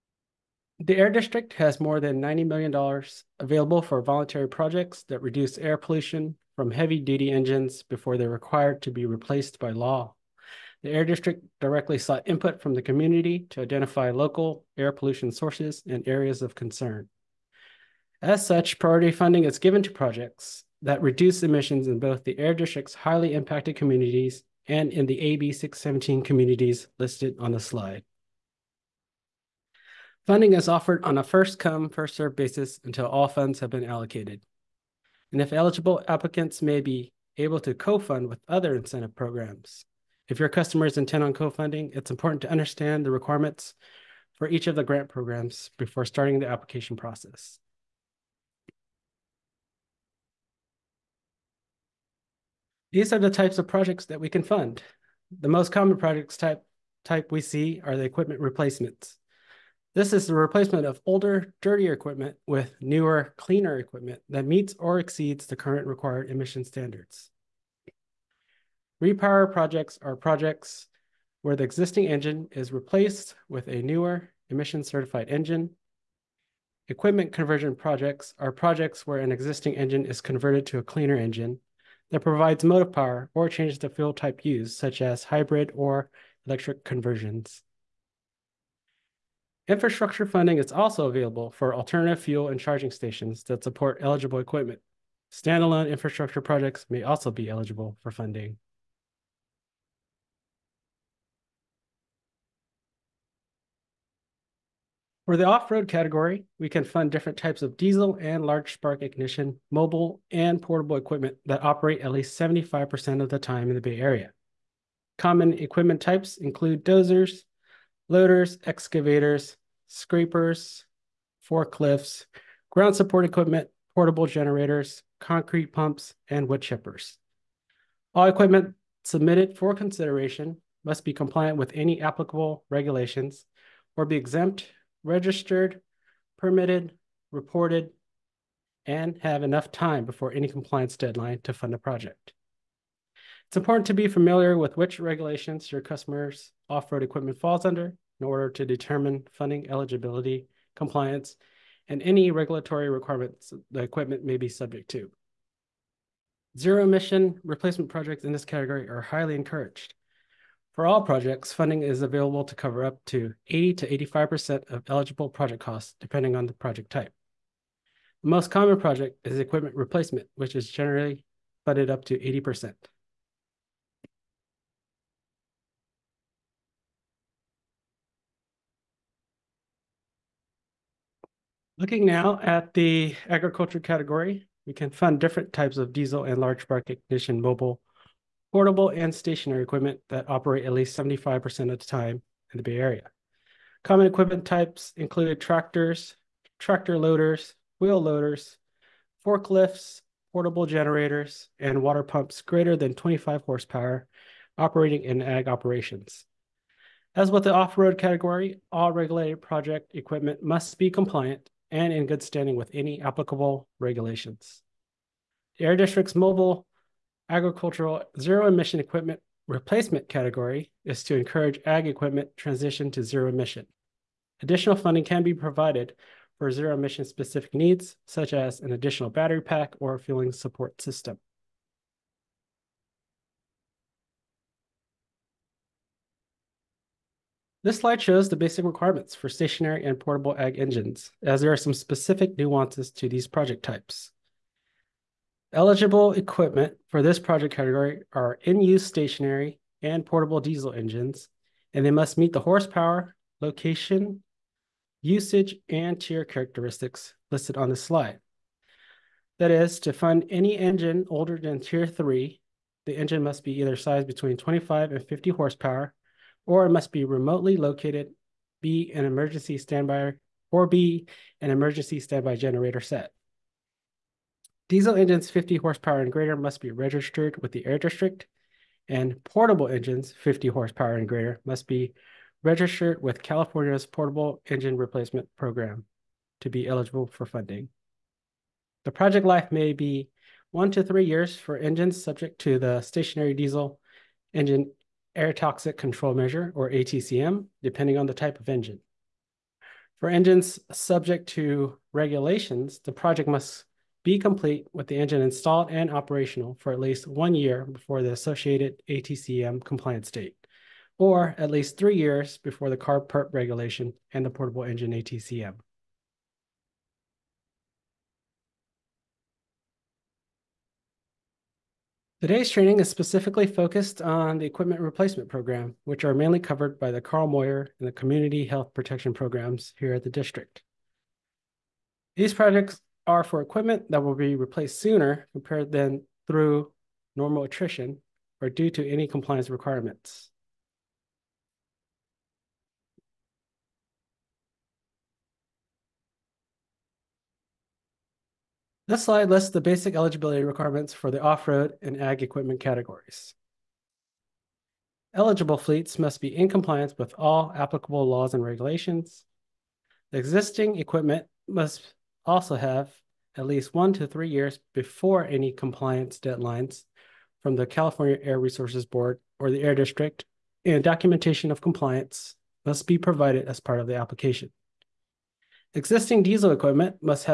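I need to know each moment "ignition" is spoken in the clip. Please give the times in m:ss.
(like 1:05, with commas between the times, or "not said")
1:49, 3:06.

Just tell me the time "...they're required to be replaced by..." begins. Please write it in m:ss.
0:08.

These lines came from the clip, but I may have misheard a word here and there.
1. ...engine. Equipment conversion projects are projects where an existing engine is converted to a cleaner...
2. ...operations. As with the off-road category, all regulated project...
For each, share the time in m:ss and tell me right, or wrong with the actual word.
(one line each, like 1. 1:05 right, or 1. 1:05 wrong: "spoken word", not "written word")
1. 1:15 right
2. 3:25 right.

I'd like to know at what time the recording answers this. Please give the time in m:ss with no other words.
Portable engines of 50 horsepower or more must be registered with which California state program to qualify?
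4:43.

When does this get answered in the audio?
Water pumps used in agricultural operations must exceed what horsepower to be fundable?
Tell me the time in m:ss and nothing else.
3:22.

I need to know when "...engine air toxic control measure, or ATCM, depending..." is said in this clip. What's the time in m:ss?
4:54.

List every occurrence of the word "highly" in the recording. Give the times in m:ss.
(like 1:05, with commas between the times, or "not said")
0:22, 2:38.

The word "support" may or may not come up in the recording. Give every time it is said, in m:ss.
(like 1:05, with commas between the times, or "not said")
1:33, 2:02, 3:50.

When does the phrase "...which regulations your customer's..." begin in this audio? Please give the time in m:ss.
2:24.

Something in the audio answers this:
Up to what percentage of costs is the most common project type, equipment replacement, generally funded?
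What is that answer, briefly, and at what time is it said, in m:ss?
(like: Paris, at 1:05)
80%, at 2:51.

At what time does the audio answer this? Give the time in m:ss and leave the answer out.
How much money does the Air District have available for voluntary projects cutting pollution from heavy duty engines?
0:01.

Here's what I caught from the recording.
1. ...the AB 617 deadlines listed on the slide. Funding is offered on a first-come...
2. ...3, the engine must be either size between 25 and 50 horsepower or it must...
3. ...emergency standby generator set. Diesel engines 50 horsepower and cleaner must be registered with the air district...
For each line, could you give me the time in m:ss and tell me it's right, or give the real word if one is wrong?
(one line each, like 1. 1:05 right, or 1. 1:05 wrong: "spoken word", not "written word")
1. 0:25 wrong: "communities", not "deadlines"
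2. 4:21 right
3. 4:31 wrong: "greater", not "cleaner".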